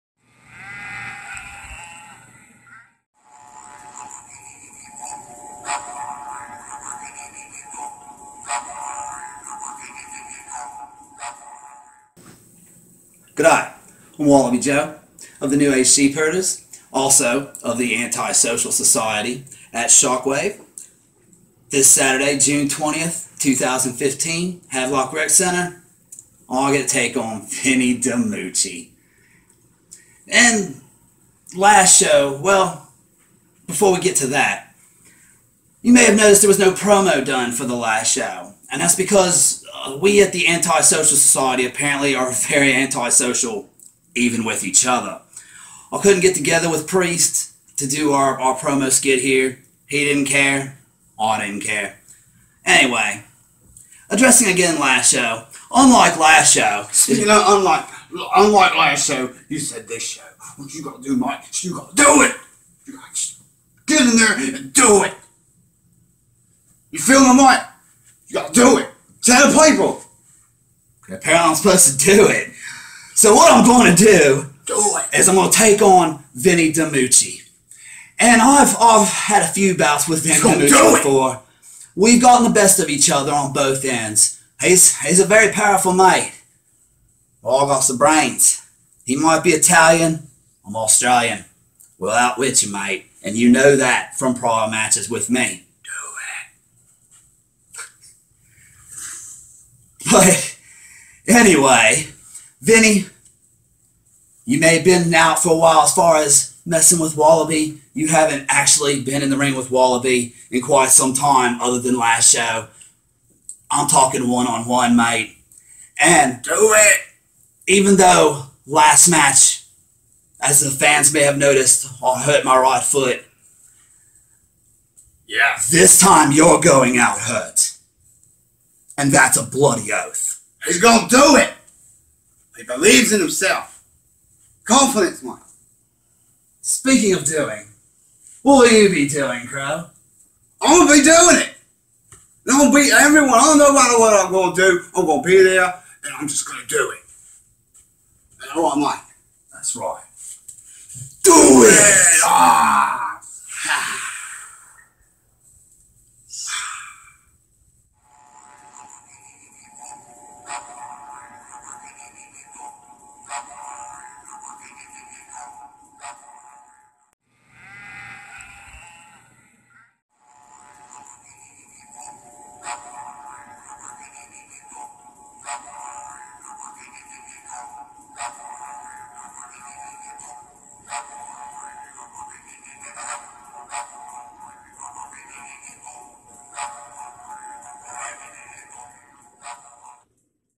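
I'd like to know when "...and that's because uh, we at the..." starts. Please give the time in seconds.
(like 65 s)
38 s.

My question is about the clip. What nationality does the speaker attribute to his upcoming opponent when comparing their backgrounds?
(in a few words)
Italian.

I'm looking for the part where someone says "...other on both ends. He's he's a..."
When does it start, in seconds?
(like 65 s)
83 s.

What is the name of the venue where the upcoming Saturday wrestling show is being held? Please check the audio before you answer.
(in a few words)
Havelock Rec Center.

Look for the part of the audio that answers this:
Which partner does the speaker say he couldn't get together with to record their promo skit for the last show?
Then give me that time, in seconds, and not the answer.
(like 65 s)
46 s.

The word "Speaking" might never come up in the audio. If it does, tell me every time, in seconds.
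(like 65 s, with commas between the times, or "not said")
136 s.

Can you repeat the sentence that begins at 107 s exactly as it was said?
You haven't actually been in the ring with Wallabee in quite some time other than last show.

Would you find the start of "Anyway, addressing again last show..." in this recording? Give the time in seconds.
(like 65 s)
52 s.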